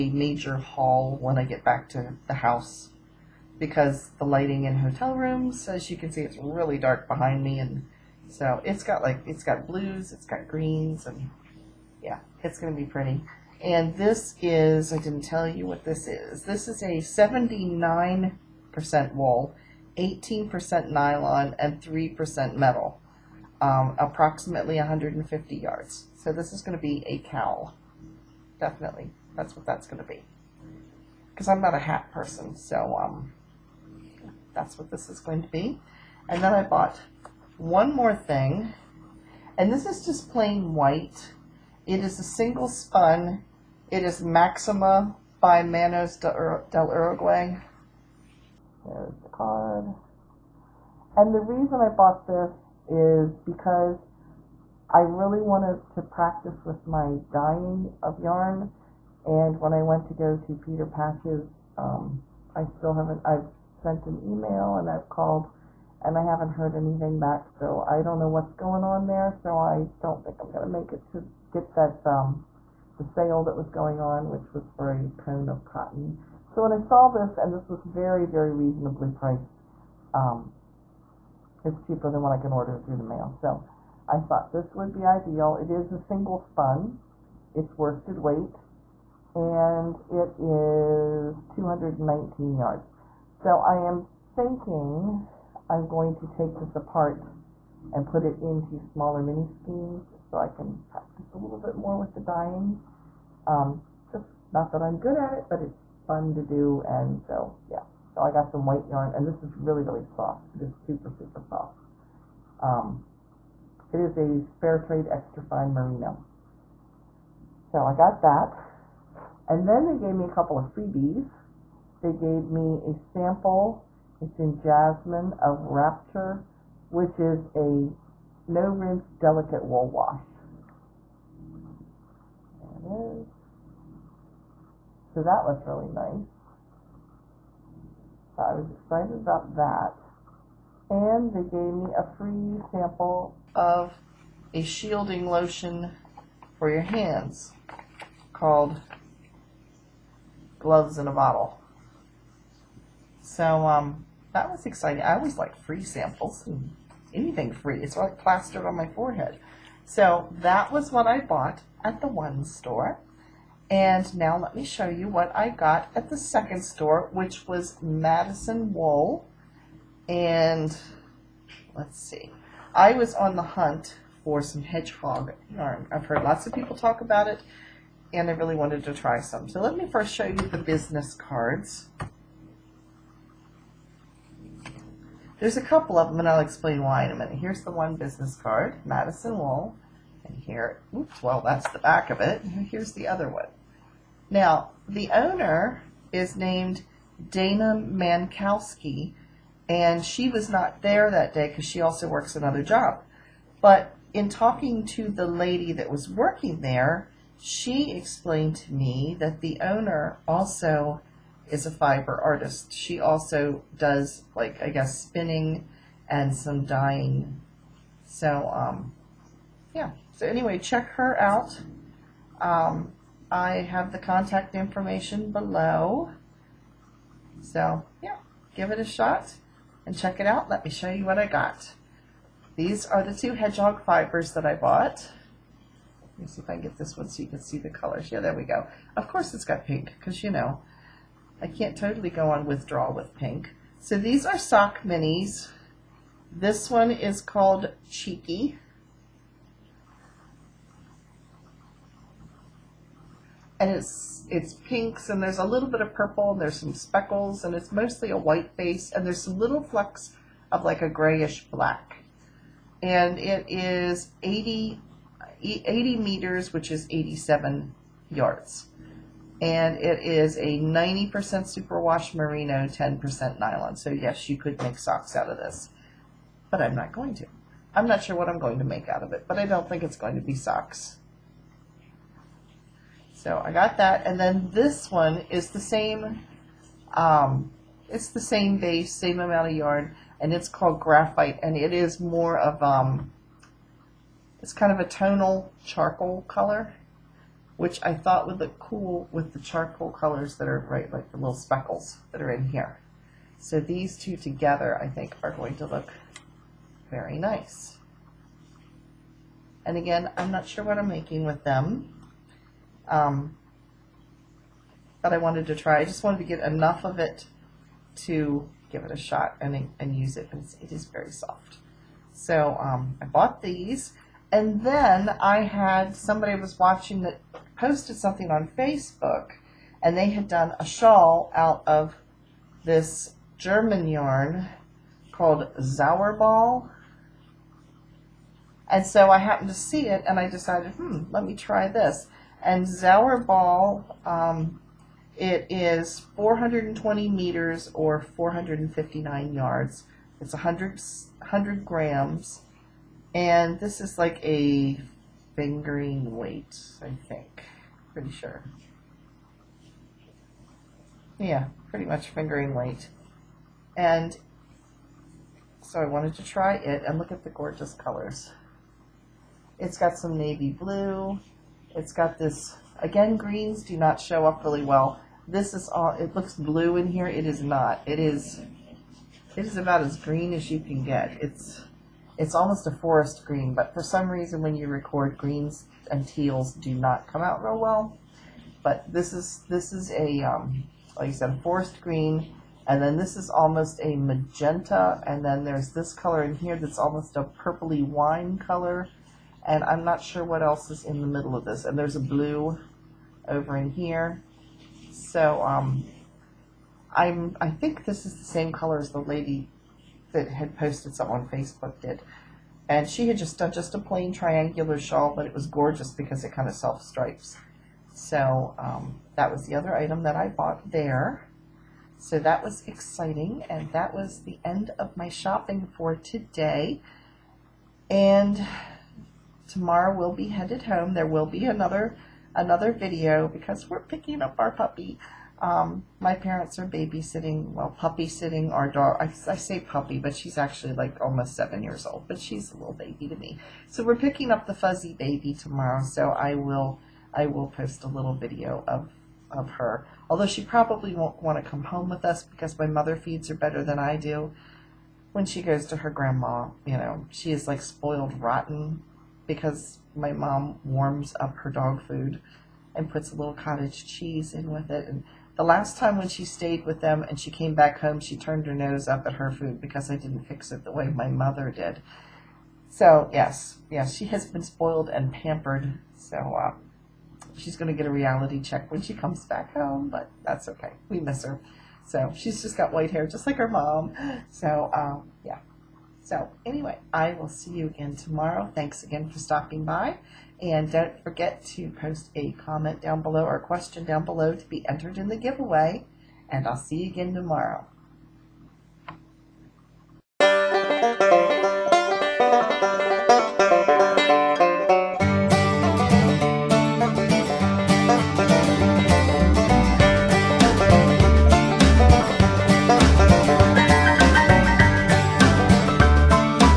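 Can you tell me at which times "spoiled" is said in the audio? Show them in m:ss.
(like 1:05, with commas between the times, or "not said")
7:37, 7:54.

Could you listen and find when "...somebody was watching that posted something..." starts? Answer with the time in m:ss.
5:25.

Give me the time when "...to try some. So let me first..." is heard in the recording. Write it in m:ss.
2:58.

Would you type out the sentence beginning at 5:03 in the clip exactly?
So these two together, I think, are going to look very nice.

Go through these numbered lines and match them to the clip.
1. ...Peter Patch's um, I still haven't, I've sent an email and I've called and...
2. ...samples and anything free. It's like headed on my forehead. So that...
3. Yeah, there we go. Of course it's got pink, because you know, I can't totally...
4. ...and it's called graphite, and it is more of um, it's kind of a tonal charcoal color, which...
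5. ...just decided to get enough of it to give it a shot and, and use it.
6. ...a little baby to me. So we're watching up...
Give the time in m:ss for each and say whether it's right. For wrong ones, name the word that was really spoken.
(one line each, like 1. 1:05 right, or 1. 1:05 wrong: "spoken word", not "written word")
1. 1:00 right
2. 2:35 wrong: "plastered", not "headed"
3. 3:58 right
4. 4:50 right
5. 5:15 wrong: "wanted", not "decided"
6. 7:22 wrong: "picking", not "watching".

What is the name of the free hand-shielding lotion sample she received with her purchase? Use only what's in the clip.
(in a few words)
Gloves in a Bottle.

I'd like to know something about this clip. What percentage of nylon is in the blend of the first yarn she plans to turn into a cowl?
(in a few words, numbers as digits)
18%.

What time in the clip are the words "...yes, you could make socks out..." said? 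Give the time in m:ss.
4:33.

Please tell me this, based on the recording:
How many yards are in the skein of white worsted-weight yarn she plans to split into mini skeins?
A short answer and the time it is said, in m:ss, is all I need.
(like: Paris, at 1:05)
219, at 1:31.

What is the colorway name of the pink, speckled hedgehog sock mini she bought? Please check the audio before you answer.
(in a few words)
Cheeky.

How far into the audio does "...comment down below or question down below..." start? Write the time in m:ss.
8:12.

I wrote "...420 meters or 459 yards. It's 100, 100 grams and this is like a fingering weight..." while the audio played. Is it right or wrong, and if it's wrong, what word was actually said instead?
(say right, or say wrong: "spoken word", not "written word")
right.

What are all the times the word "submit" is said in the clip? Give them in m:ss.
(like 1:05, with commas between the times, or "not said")
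not said.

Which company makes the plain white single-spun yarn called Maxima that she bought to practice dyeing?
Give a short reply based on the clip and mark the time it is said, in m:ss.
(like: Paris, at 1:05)
Manos del Uruguay, at 0:45.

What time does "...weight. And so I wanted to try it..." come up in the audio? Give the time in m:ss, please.
6:02.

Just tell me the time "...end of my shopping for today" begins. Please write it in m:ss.
7:04.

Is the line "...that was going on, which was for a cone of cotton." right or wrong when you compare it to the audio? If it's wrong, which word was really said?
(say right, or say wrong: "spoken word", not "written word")
right.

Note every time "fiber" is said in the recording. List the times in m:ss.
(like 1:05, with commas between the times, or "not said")
3:31, 3:53.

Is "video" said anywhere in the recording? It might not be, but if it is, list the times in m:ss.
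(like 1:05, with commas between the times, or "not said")
7:12, 7:28.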